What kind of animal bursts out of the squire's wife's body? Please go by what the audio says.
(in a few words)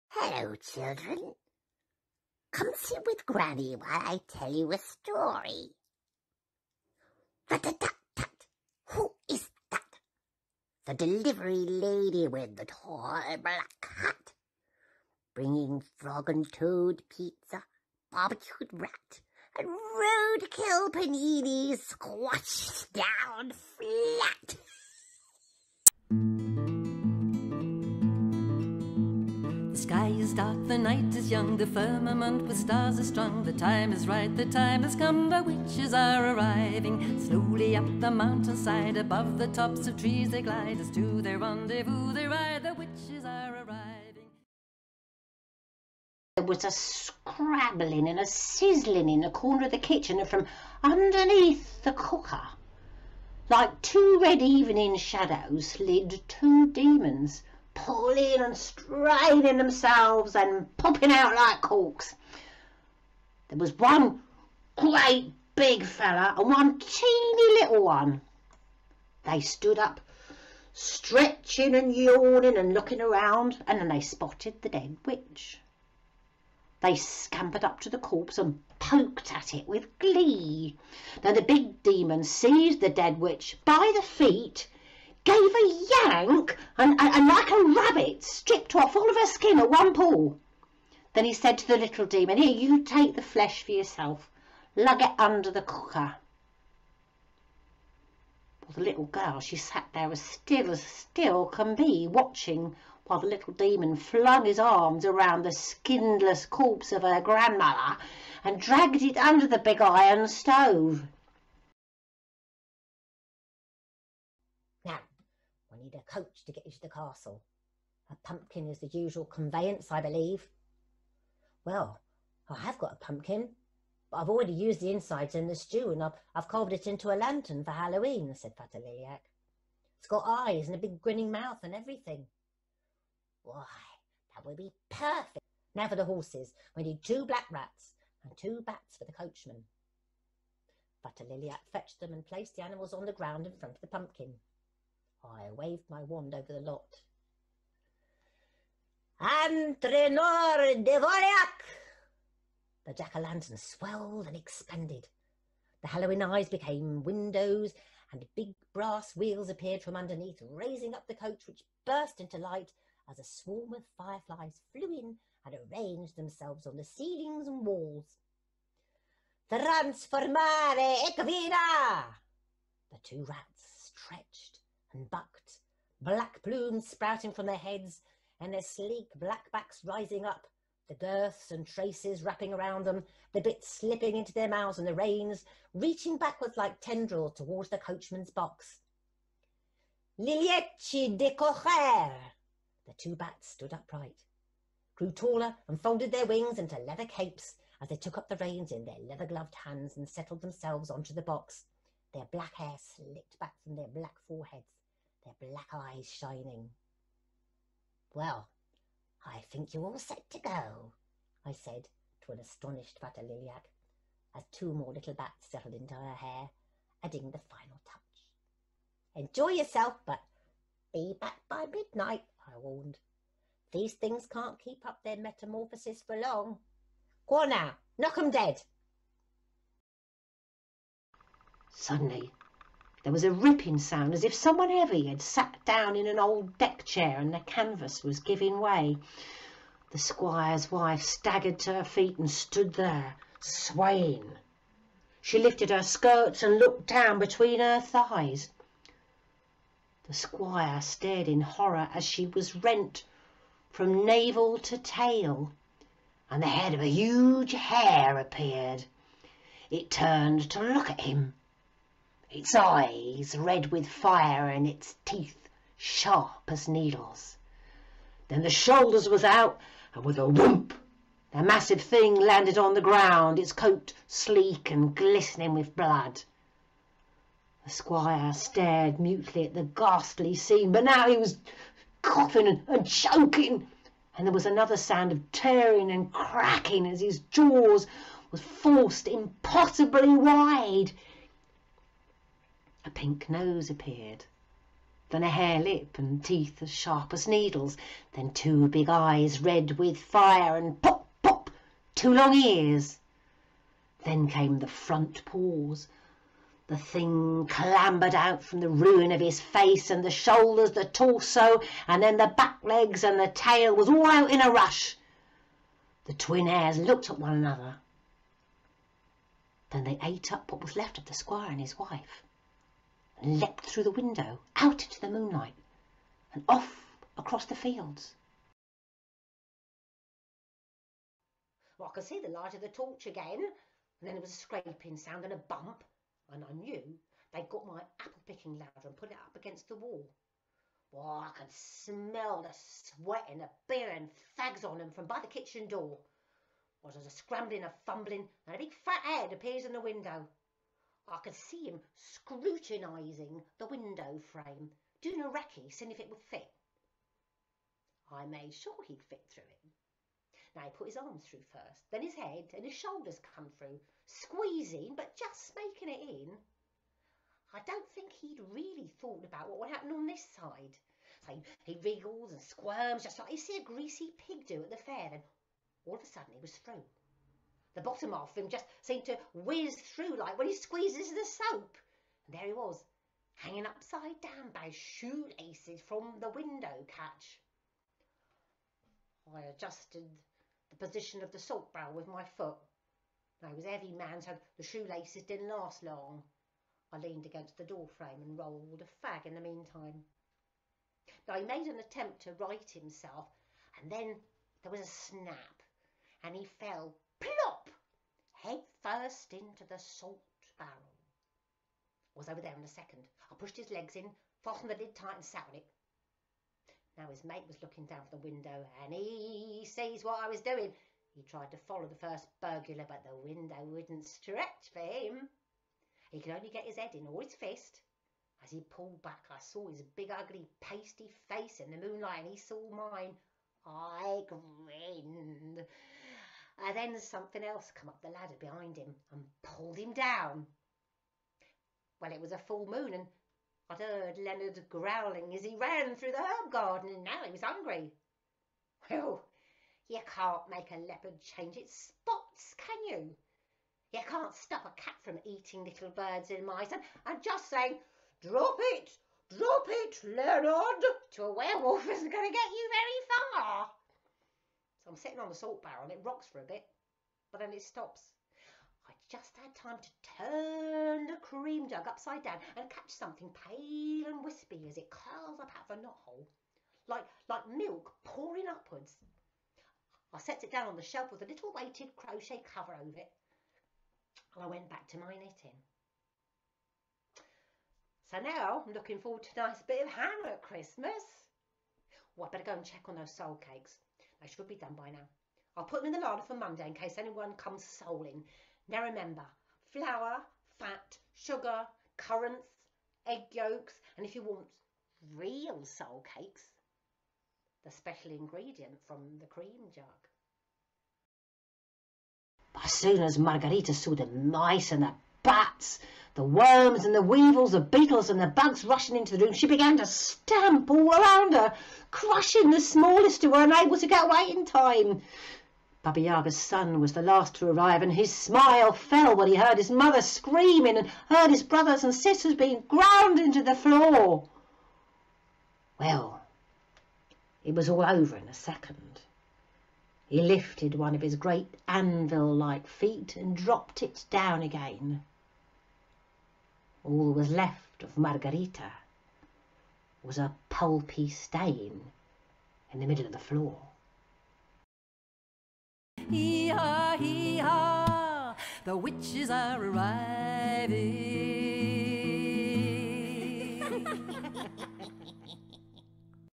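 a huge hare.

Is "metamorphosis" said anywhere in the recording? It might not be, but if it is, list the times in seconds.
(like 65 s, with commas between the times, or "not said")
225 s.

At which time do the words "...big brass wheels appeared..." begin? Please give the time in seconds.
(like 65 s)
158 s.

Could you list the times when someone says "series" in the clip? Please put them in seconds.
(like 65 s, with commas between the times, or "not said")
not said.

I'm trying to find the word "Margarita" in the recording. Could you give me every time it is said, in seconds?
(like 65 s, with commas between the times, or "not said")
513 s, 547 s.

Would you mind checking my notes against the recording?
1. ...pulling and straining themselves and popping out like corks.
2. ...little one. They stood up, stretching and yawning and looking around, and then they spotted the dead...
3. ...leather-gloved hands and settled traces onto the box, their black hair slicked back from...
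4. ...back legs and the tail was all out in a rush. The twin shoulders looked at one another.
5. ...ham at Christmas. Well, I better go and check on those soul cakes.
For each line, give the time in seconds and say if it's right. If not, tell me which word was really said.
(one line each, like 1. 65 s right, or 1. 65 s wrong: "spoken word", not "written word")
1. 57 s right
2. 67 s right
3. 199 s wrong: "themselves", not "traces"
4. 312 s wrong: "heirs", not "shoulders"
5. 489 s right.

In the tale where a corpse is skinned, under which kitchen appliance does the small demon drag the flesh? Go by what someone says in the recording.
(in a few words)
the big iron stove.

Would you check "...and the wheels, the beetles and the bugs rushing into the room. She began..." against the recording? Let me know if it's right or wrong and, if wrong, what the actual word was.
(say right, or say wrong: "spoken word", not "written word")
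wrong: "weevils", not "wheels".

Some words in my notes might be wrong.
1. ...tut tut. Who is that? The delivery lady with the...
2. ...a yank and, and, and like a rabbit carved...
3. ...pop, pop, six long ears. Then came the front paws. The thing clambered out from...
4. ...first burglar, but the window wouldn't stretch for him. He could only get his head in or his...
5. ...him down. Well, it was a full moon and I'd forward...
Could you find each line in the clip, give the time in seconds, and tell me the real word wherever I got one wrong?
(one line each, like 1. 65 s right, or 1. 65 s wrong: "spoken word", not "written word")
1. 7 s right
2. 85 s wrong: "stripped", not "carved"
3. 300 s wrong: "two", not "six"
4. 422 s right
5. 439 s wrong: "heard", not "forward".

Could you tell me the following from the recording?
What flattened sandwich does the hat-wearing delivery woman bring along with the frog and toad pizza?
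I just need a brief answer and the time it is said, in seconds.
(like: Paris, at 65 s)
roadkill panini, at 19 s.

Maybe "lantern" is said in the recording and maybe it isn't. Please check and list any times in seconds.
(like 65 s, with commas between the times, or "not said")
127 s, 152 s.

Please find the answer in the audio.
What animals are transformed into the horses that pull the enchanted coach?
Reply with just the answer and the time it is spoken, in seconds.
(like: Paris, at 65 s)
two black rats, at 137 s.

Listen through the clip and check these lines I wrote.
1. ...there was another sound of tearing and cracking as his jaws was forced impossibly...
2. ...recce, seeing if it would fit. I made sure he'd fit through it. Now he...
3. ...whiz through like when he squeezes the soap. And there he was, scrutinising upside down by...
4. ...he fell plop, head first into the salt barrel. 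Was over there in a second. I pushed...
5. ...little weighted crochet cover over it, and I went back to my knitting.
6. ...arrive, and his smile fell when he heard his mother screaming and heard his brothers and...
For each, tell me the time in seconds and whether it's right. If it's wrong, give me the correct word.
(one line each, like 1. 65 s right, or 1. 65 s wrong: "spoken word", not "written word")
1. 284 s right
2. 355 s right
3. 379 s wrong: "hanging", not "scrutinising"
4. 406 s right
5. 481 s right
6. 527 s right.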